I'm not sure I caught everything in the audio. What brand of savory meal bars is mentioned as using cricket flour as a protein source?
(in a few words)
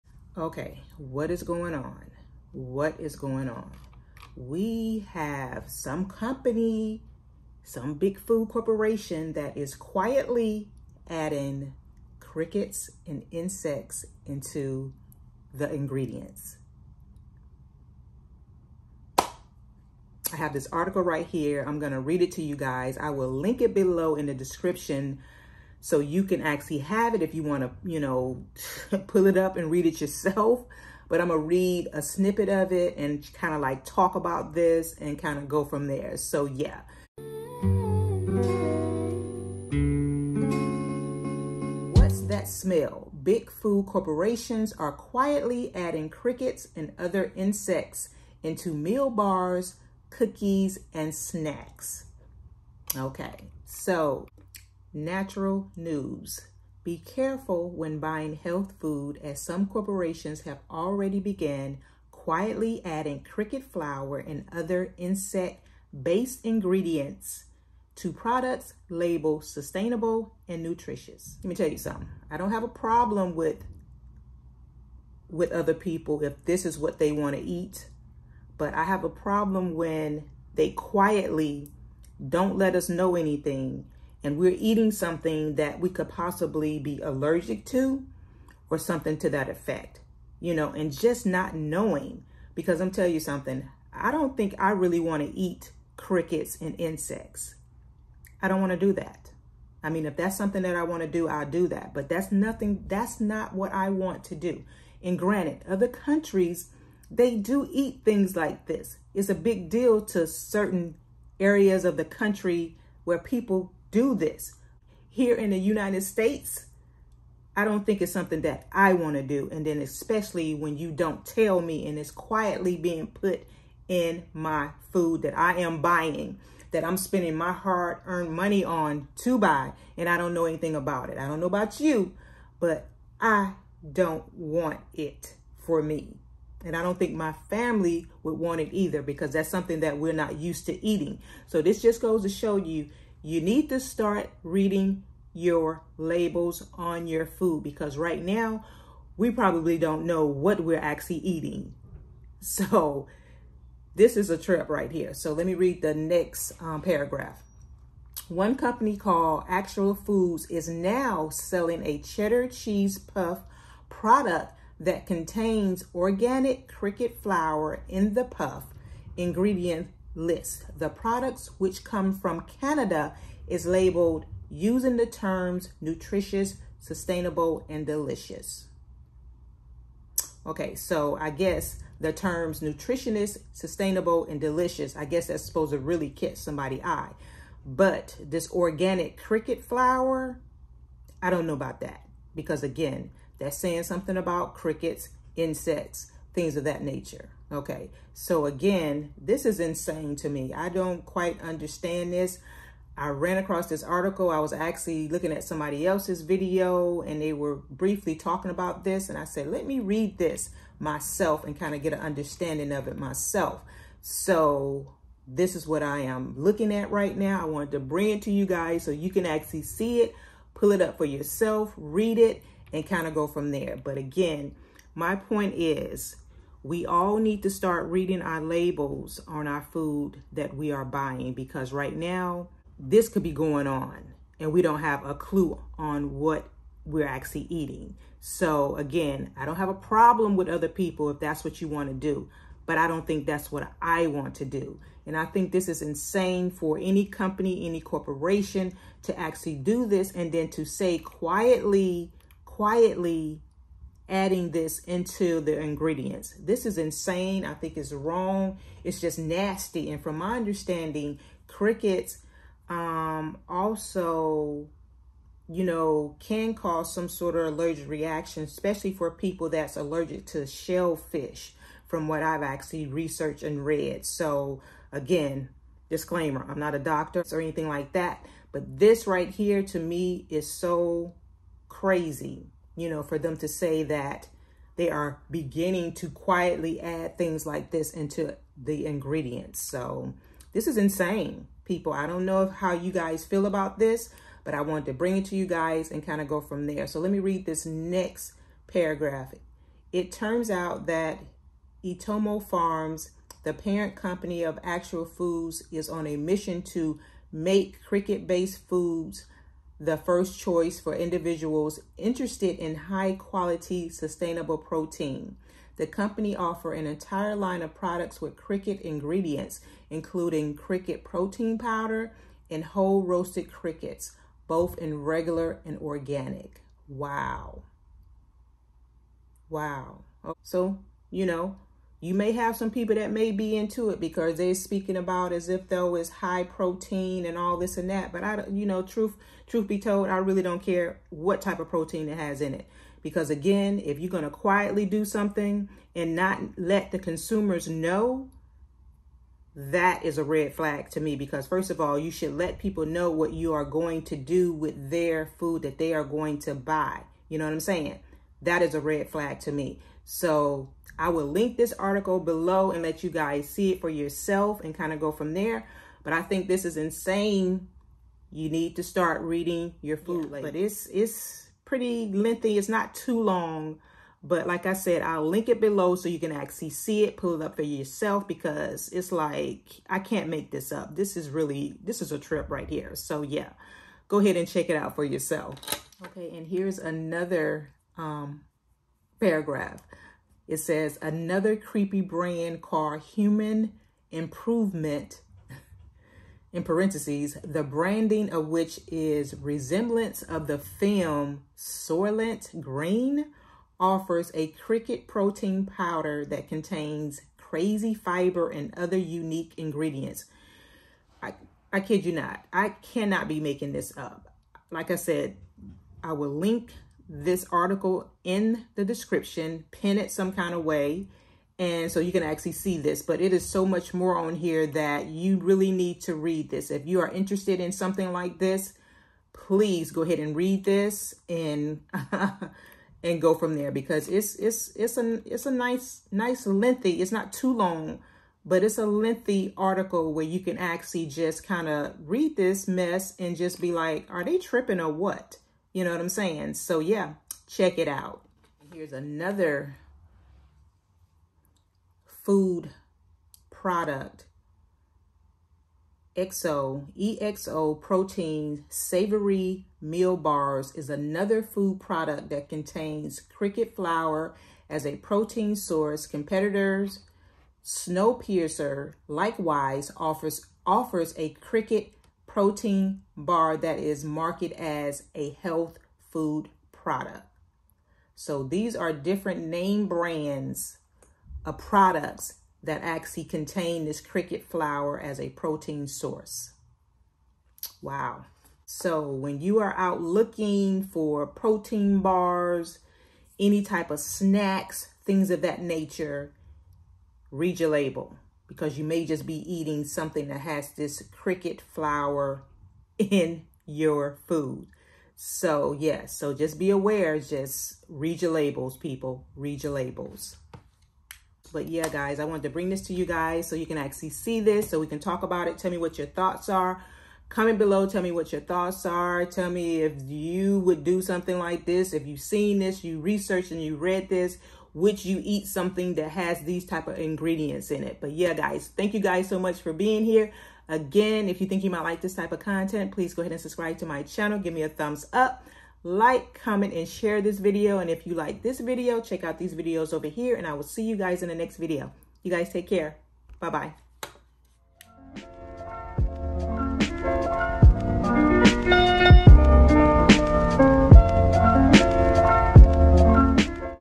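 EXO.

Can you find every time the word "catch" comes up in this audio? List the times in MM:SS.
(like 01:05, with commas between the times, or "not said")
03:06.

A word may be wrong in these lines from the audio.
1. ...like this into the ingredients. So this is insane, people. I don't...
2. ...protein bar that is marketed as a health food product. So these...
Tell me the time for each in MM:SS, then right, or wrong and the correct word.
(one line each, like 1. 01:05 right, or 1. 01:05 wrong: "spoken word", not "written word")
1. 04:47 right
2. 07:52 right.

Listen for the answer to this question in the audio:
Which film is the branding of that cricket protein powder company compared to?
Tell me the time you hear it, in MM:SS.
06:41.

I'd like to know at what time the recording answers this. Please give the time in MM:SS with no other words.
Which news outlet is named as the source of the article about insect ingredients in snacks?
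00:54.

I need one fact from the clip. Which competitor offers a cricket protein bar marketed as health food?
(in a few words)
Snowpiercer.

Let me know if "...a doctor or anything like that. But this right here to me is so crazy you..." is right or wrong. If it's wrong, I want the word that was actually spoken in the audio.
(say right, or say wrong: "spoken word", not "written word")
right.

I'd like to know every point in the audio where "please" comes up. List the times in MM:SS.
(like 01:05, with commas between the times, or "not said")
07:09, 08:52.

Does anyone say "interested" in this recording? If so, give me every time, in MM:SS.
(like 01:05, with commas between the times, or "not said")
05:11, 07:07.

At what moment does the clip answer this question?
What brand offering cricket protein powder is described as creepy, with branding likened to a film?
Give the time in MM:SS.
06:33.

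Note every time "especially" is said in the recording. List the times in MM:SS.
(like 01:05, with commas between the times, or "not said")
01:59, 04:28.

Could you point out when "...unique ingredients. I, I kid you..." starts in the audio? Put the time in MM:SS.
06:48.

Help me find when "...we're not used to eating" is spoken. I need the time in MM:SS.
02:19.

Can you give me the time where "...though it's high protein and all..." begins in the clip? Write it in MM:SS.
05:35.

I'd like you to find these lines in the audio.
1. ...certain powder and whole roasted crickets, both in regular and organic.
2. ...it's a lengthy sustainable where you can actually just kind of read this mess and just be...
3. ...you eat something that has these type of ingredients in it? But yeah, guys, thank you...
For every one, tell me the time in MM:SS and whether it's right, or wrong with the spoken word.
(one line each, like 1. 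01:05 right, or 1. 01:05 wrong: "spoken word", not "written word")
1. 05:21 wrong: "protein", not "certain"
2. 07:18 wrong: "article", not "sustainable"
3. 08:45 right.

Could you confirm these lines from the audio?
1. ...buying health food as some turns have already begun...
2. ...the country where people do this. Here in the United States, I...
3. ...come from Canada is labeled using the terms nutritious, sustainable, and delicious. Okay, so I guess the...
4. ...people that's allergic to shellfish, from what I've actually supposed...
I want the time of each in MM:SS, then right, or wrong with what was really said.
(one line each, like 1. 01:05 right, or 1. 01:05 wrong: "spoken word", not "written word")
1. 00:57 wrong: "corporations", not "turns"
2. 01:51 right
3. 02:51 right
4. 04:29 wrong: "researched", not "supposed".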